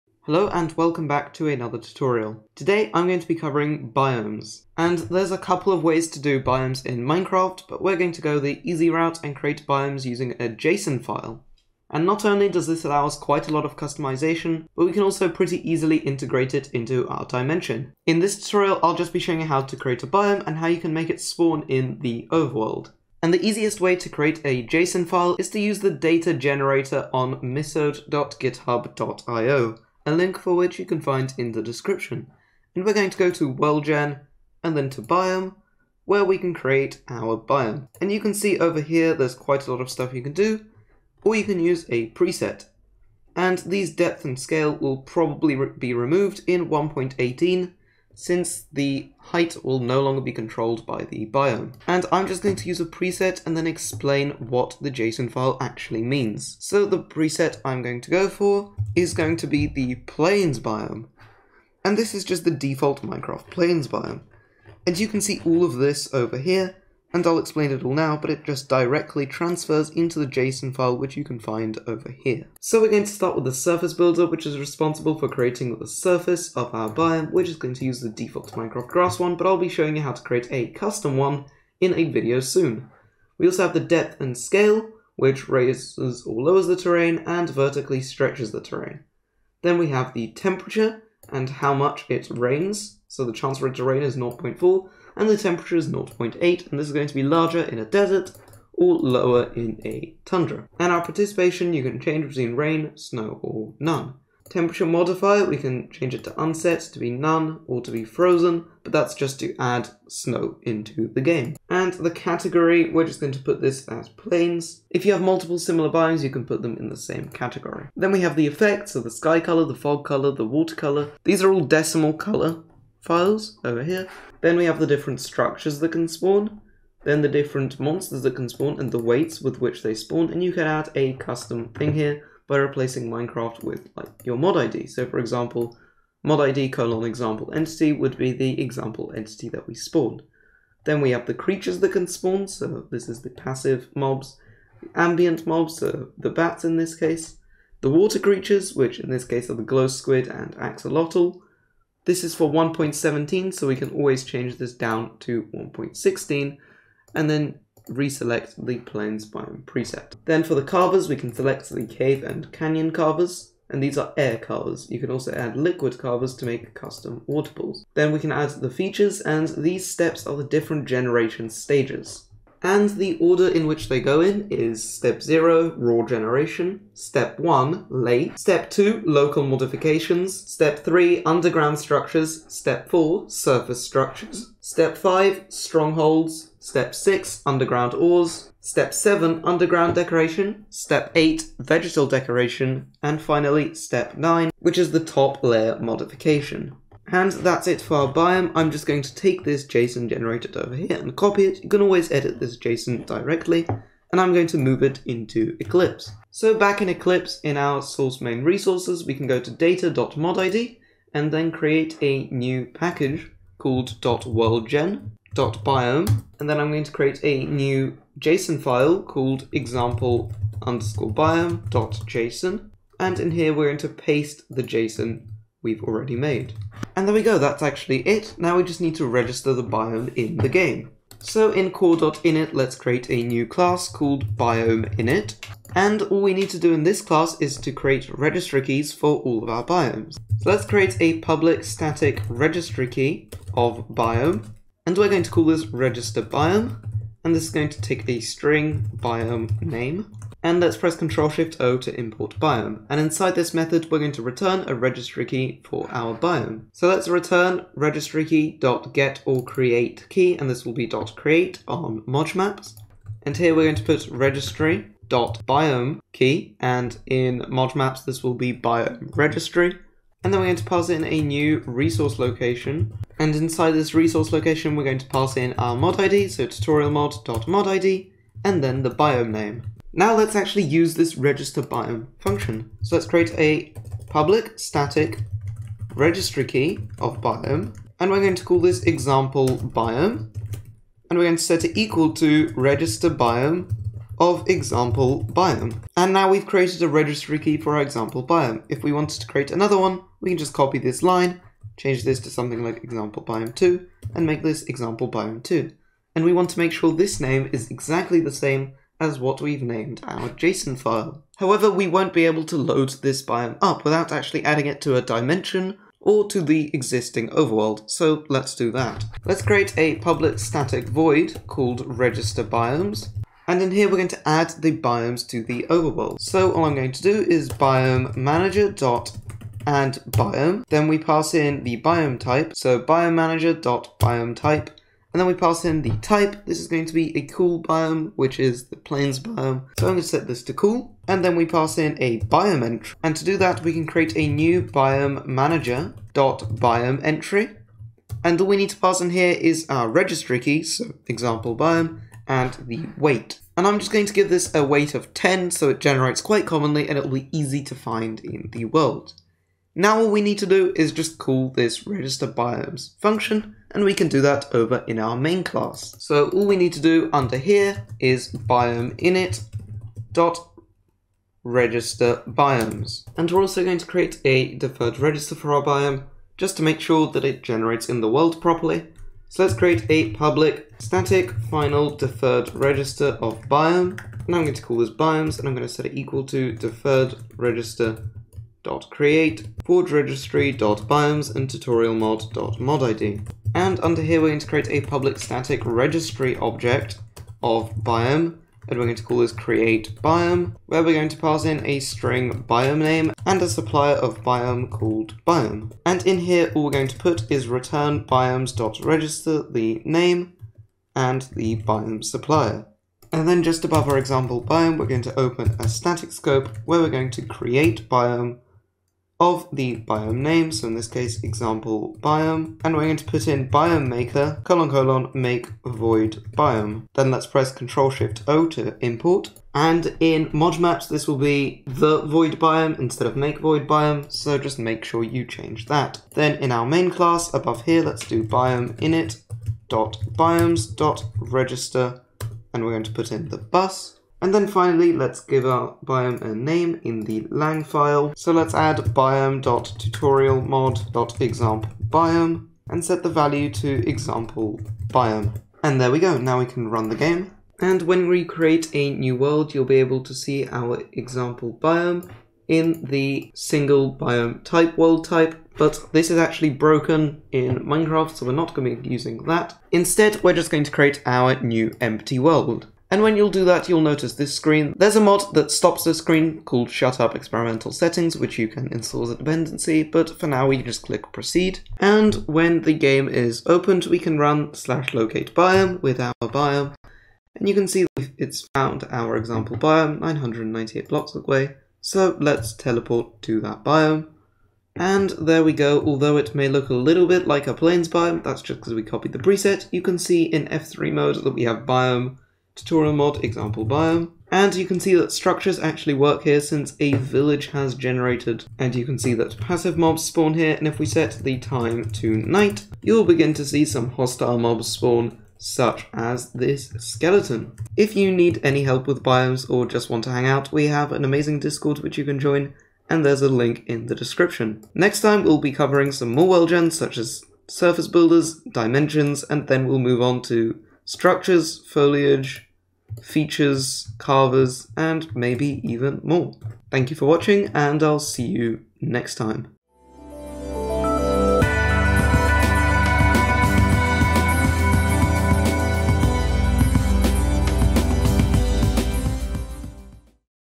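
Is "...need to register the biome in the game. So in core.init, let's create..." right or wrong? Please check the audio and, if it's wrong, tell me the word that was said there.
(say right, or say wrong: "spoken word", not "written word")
right.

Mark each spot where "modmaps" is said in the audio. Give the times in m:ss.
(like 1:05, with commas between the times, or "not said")
4:22, 4:27.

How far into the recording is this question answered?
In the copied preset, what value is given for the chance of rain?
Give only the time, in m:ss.
1:34.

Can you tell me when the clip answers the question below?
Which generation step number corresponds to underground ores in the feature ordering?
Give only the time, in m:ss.
3:06.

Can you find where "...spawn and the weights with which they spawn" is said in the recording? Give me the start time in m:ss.
2:08.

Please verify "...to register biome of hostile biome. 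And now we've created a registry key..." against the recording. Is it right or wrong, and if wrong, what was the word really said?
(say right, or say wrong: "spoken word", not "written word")
wrong: "example", not "hostile".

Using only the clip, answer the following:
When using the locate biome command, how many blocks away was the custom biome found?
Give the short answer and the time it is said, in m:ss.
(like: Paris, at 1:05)
998, at 8:10.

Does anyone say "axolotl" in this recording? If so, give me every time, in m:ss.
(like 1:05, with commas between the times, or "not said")
2:30.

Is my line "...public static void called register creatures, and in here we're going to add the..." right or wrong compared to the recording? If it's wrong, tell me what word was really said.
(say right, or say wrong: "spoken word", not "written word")
wrong: "biomes", not "creatures".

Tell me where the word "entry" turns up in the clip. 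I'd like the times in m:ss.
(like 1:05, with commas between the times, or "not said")
5:42, 5:47.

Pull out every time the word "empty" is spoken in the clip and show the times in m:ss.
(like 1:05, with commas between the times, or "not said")
7:51.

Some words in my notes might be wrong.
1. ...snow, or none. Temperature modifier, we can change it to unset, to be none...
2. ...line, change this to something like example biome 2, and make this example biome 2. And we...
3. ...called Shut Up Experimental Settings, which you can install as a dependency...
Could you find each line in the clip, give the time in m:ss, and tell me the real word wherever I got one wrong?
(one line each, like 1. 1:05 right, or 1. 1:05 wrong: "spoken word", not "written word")
1. 1:42 right
2. 5:01 right
3. 7:56 right.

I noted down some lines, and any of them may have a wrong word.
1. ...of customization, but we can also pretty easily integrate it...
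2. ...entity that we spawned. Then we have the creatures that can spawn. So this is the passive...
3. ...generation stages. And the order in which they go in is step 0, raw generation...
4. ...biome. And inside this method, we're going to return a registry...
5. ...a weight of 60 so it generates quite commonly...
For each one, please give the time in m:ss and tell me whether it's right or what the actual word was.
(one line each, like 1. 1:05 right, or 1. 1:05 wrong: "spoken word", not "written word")
1. 0:13 right
2. 2:19 right
3. 2:50 right
4. 4:12 right
5. 5:54 wrong: "10", not "60".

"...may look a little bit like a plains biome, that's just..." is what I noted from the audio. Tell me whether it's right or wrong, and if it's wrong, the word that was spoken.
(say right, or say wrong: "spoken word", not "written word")
right.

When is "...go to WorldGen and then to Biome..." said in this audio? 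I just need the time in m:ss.
0:33.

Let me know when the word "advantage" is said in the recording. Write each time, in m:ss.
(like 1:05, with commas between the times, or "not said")
not said.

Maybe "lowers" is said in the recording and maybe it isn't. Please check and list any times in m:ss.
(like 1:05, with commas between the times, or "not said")
1:26, 1:38.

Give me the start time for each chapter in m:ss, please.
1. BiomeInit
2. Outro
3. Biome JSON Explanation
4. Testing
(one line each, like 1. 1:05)
1. 3:26
2. 8:36
3. 0:22
4. 7:36.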